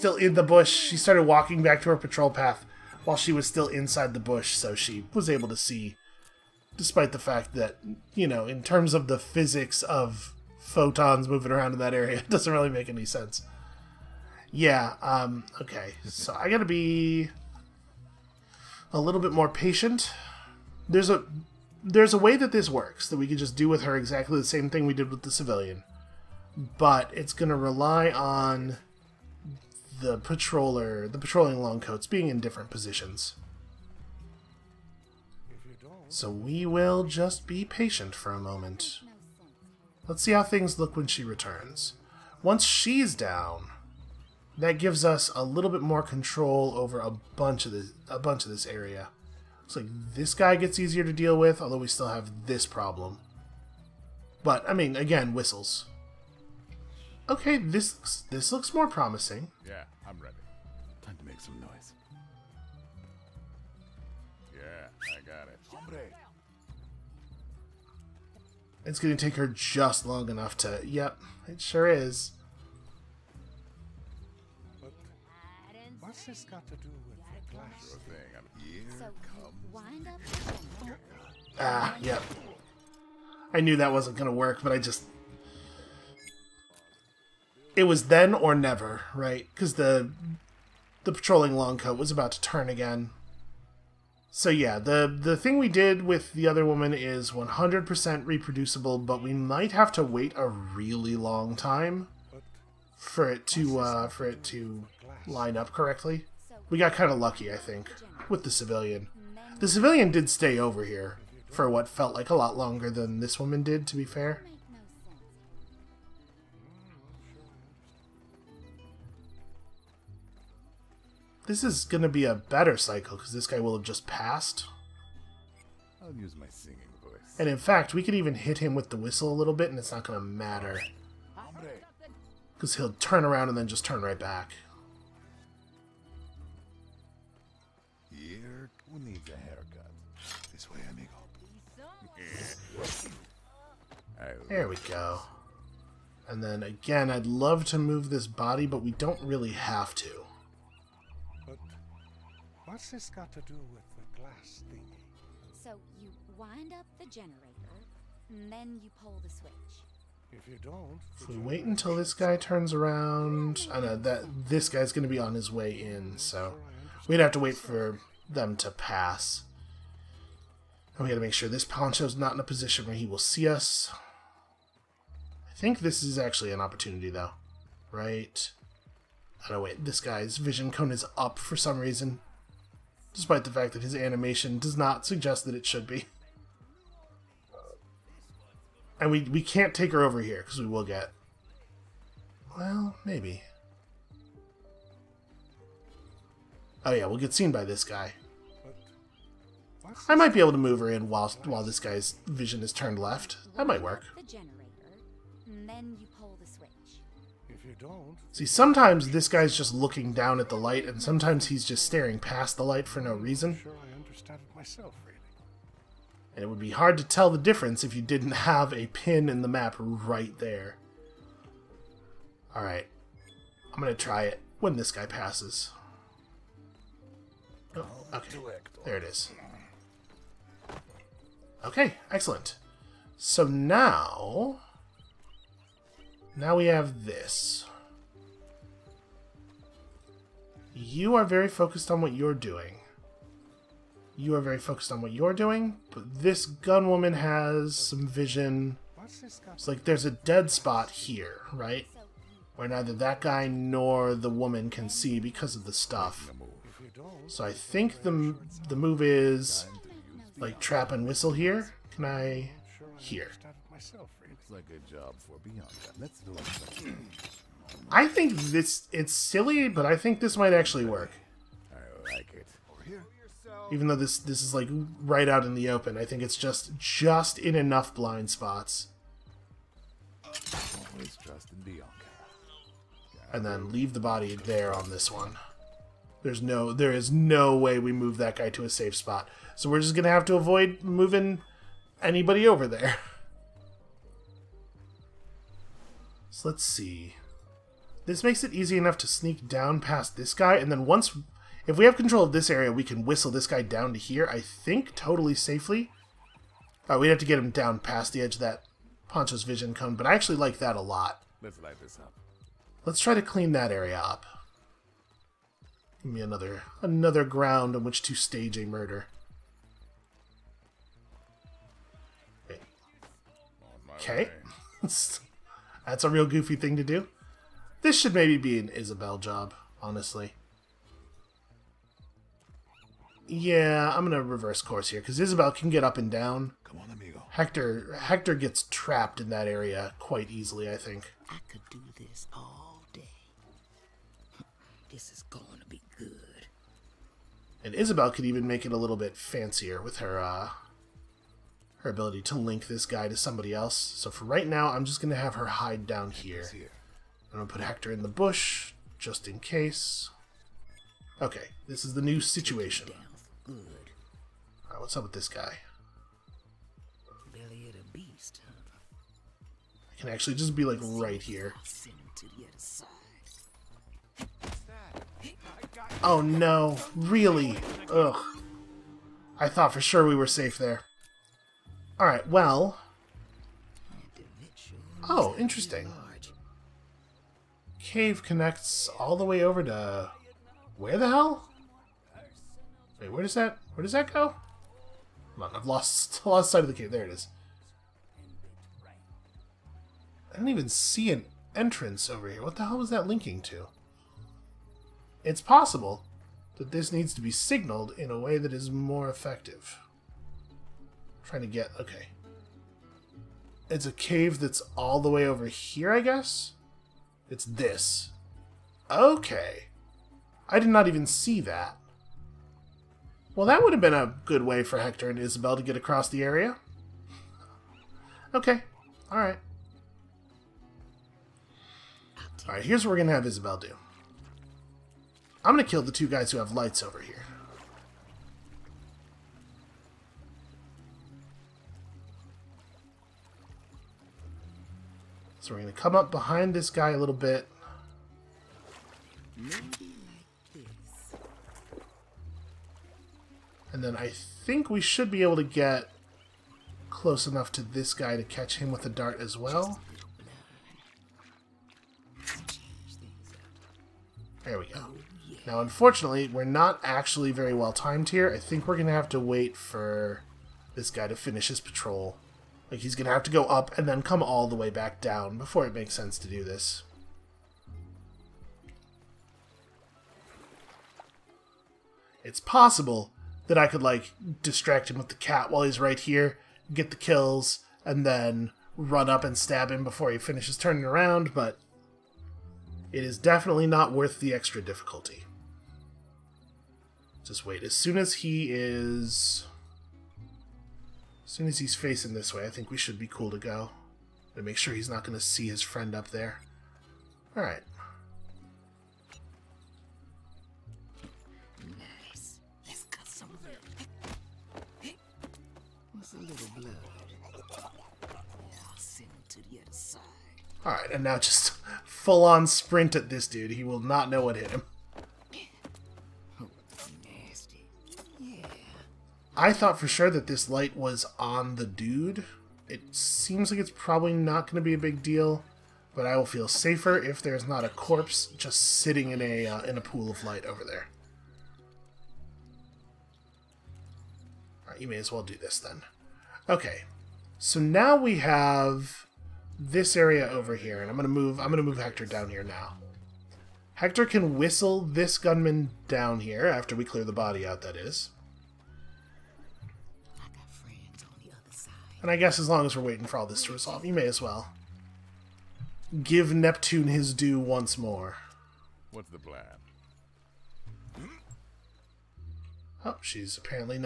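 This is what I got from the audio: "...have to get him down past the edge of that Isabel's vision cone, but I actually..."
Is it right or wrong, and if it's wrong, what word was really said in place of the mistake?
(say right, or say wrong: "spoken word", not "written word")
wrong: "Poncho", not "Isabel".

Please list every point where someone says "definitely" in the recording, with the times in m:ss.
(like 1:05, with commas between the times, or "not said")
8:13.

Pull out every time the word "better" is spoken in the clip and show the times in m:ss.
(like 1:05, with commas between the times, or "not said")
2:02.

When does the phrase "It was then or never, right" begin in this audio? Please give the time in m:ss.
1:27.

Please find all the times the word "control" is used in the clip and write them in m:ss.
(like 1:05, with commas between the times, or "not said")
0:46, 5:01.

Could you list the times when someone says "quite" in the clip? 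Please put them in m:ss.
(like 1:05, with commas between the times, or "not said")
5:39.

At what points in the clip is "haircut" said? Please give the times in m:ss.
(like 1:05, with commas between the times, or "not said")
2:19.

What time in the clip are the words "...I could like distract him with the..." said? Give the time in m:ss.
8:03.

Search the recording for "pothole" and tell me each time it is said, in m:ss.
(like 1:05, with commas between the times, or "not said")
not said.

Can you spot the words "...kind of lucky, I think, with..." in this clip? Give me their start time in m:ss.
1:46.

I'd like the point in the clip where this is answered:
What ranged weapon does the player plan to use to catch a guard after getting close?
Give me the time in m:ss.
7:38.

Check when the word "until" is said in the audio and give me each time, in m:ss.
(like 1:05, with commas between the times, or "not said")
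2:41.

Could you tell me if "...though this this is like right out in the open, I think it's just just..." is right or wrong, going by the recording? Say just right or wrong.
right.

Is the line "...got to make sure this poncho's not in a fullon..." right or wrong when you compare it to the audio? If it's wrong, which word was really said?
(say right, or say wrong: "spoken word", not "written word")
wrong: "position", not "fullon".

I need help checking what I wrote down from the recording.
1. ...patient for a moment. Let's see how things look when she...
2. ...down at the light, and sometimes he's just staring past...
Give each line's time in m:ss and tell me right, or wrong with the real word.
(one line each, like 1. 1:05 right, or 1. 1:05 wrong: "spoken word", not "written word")
1. 0:37 right
2. 3:30 right.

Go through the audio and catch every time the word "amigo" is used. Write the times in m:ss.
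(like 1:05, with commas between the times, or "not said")
2:20, 5:36.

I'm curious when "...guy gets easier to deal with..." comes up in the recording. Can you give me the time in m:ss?
0:50.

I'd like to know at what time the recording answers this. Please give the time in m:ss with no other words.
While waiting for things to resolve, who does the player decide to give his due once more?
9:26.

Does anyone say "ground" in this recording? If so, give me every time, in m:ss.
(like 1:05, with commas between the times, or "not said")
5:17.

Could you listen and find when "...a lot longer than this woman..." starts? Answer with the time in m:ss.
1:52.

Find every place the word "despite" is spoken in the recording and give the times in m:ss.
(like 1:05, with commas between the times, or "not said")
0:06, 3:03.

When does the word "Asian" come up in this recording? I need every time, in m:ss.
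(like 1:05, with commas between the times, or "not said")
not said.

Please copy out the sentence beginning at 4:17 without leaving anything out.
So I think the, the move is like trap and whistle here.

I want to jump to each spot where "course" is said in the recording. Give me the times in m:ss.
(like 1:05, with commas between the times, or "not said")
5:34.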